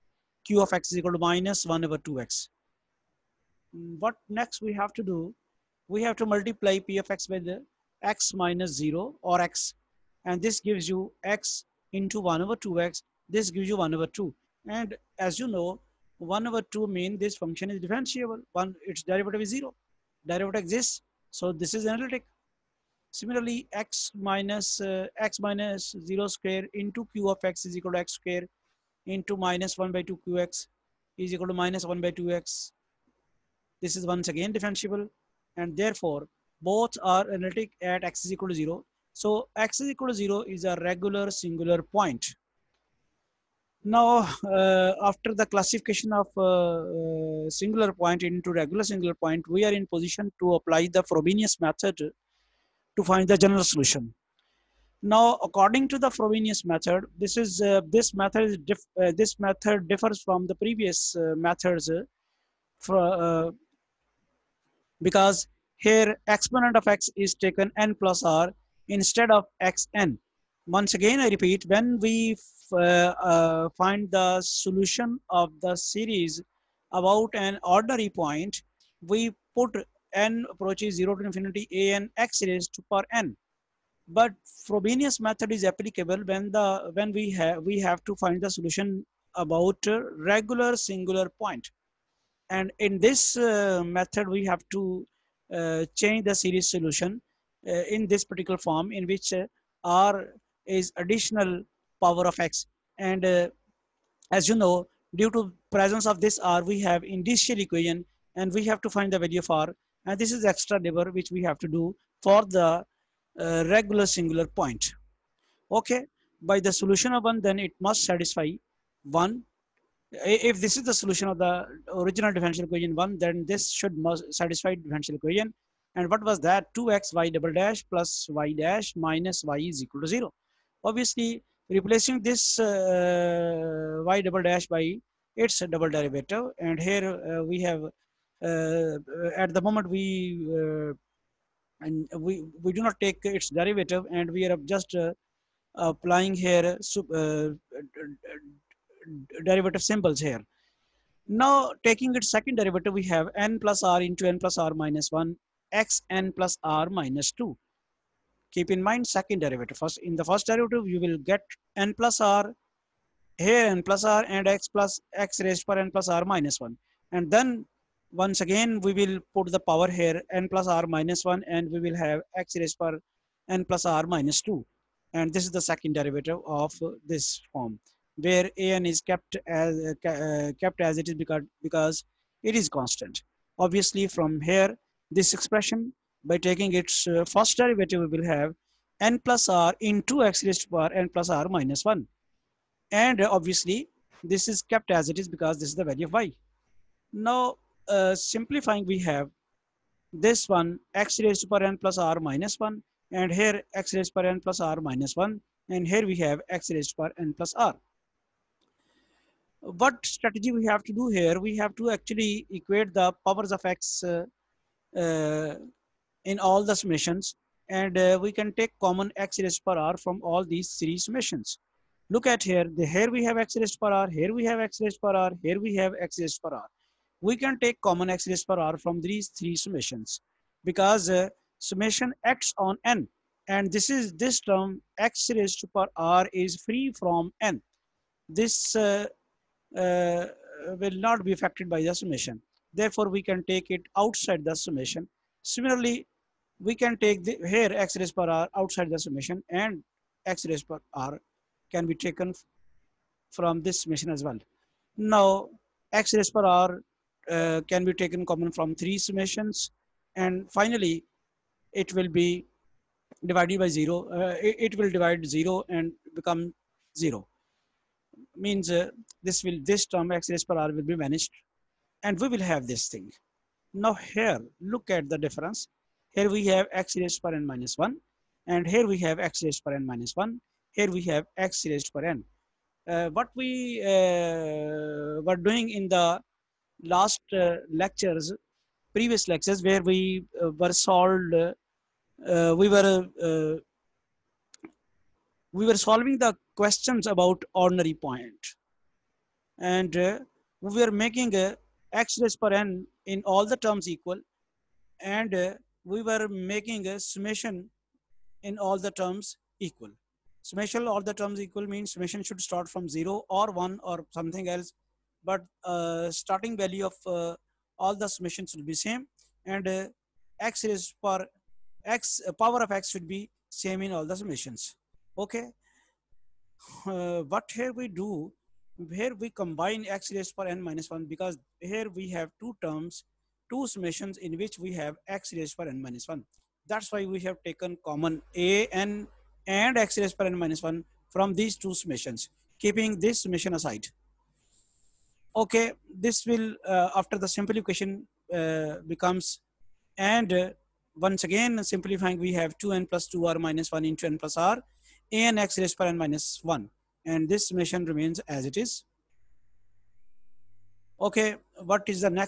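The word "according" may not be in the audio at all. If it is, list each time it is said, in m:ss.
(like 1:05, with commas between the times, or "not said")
0:55.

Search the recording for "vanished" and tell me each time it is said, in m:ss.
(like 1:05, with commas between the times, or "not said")
4:31.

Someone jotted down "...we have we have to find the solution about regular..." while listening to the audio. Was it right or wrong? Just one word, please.
right.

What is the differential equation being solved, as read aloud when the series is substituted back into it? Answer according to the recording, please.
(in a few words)
2xy'' + y' - y = 0.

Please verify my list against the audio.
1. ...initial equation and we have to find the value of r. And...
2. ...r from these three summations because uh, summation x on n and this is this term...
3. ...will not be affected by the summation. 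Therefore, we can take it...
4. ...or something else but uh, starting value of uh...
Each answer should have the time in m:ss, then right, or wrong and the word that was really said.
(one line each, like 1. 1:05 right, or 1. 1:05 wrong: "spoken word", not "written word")
1. 1:47 right
2. 3:48 right
3. 4:00 right
4. 5:13 right.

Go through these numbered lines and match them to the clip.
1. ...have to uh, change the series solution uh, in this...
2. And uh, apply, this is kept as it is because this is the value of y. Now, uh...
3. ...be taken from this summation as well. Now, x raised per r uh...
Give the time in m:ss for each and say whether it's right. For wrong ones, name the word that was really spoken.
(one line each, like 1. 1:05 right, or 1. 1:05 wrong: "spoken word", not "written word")
1. 1:34 right
2. 3:13 wrong: "obviously", not "apply"
3. 4:11 right.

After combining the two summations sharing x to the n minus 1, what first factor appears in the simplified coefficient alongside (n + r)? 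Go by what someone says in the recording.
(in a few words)
2n + 2r - 1.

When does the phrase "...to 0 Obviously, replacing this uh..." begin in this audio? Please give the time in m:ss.
2:10.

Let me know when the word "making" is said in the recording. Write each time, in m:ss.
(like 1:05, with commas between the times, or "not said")
5:00, 5:06.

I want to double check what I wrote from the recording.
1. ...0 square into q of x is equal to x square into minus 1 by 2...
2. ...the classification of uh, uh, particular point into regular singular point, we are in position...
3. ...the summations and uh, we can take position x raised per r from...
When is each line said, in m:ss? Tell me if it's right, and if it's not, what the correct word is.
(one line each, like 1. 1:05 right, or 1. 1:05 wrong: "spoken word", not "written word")
1. 0:26 right
2. 0:45 wrong: "singular", not "particular"
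3. 3:36 wrong: "common", not "position".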